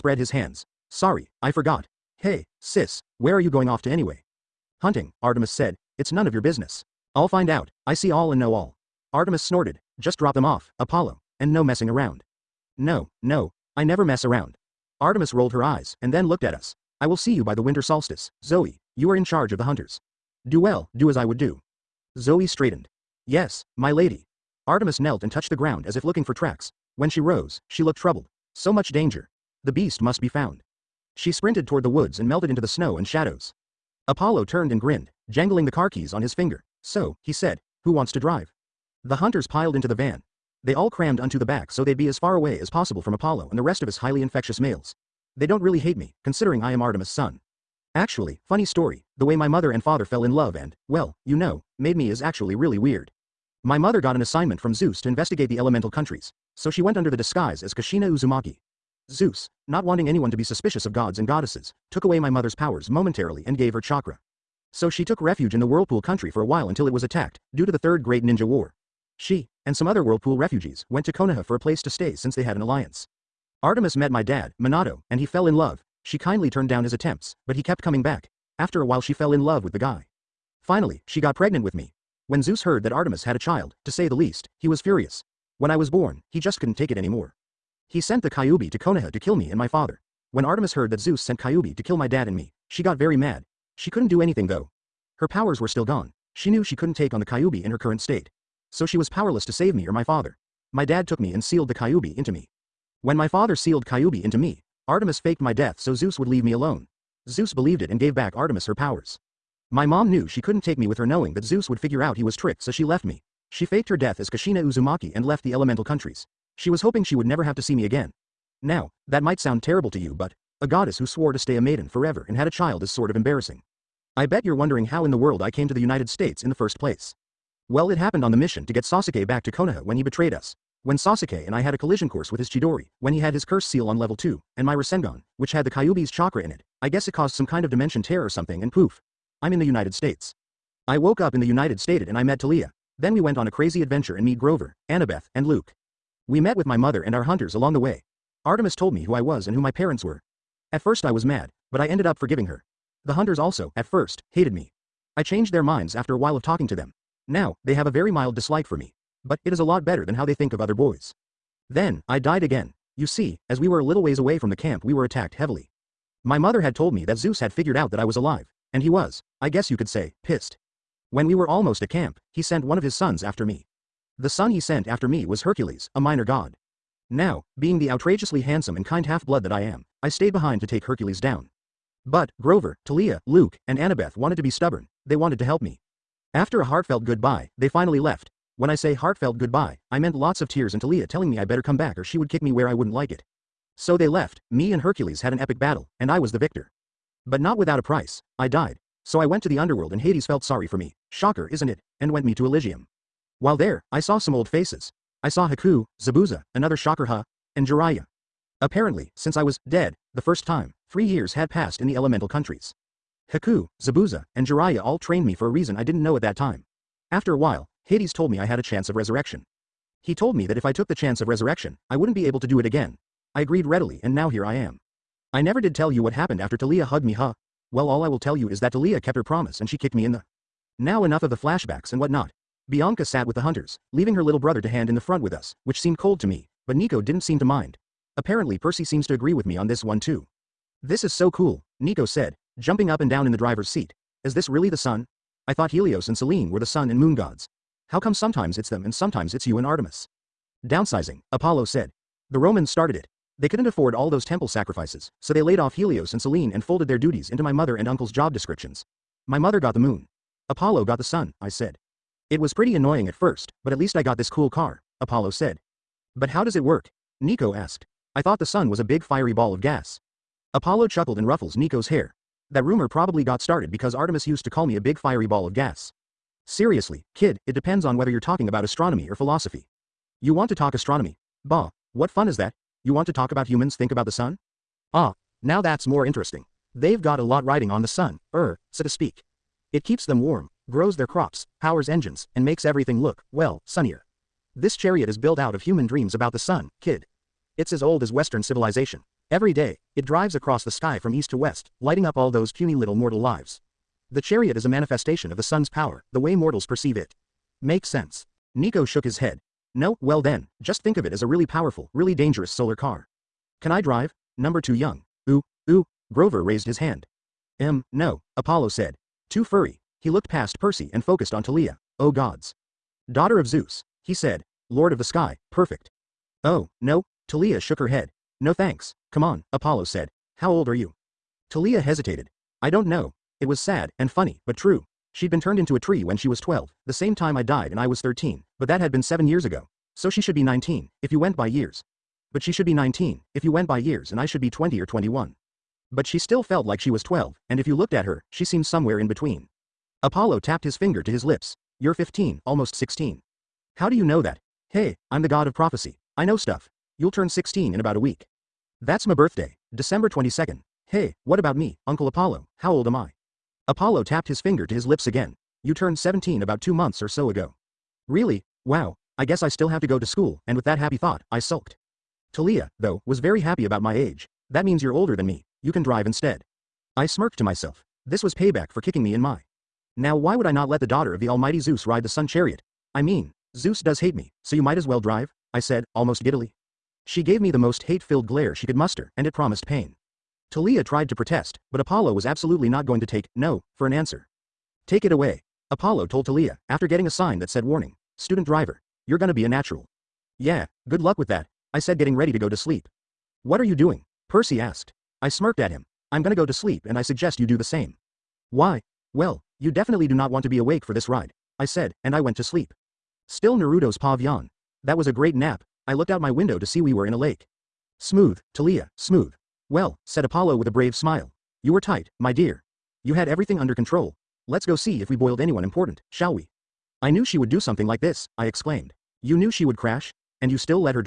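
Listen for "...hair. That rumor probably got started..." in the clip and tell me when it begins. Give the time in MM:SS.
04:31.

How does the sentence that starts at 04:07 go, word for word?
How come sometimes it's them and sometimes it's you and Artemis?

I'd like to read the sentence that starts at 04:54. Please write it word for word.
This chariot is built out of human dreams about the sun, kid.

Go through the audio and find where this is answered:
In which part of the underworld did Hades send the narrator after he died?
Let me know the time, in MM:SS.
03:22.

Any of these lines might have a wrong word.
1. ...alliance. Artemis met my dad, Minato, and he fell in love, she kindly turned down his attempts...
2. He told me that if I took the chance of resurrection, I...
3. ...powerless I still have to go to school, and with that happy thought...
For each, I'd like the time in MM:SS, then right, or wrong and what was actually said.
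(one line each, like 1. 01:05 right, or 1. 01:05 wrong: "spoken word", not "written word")
1. 01:12 right
2. 03:40 right
3. 06:09 wrong: "guess", not "powerless".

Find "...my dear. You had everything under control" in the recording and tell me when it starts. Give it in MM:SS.
07:02.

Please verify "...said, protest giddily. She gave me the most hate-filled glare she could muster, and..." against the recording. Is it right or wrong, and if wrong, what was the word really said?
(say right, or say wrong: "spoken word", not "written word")
wrong: "almost", not "protest".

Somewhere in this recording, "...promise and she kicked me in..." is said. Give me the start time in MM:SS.
03:49.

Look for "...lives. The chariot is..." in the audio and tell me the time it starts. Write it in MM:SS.
05:03.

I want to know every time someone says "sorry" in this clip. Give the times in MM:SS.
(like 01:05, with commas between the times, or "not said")
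00:00, 03:20.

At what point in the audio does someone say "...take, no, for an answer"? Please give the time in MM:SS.
06:33.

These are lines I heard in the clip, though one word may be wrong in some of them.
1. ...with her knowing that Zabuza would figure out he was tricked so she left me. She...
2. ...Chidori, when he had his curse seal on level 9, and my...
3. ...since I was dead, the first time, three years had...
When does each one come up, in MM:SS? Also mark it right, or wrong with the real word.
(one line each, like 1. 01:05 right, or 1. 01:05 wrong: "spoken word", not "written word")
1. 01:50 wrong: "Zeus", not "Zabuza"
2. 02:12 wrong: "2", not "9"
3. 03:29 right.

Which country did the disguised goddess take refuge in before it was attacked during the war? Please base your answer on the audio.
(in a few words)
Whirlpool country.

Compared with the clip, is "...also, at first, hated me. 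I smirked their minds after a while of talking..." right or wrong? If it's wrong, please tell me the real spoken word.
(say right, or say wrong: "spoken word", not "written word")
wrong: "changed", not "smirked".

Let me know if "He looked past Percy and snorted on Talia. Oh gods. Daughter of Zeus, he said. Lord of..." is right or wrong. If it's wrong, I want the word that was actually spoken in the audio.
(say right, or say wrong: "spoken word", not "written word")
wrong: "focused", not "snorted".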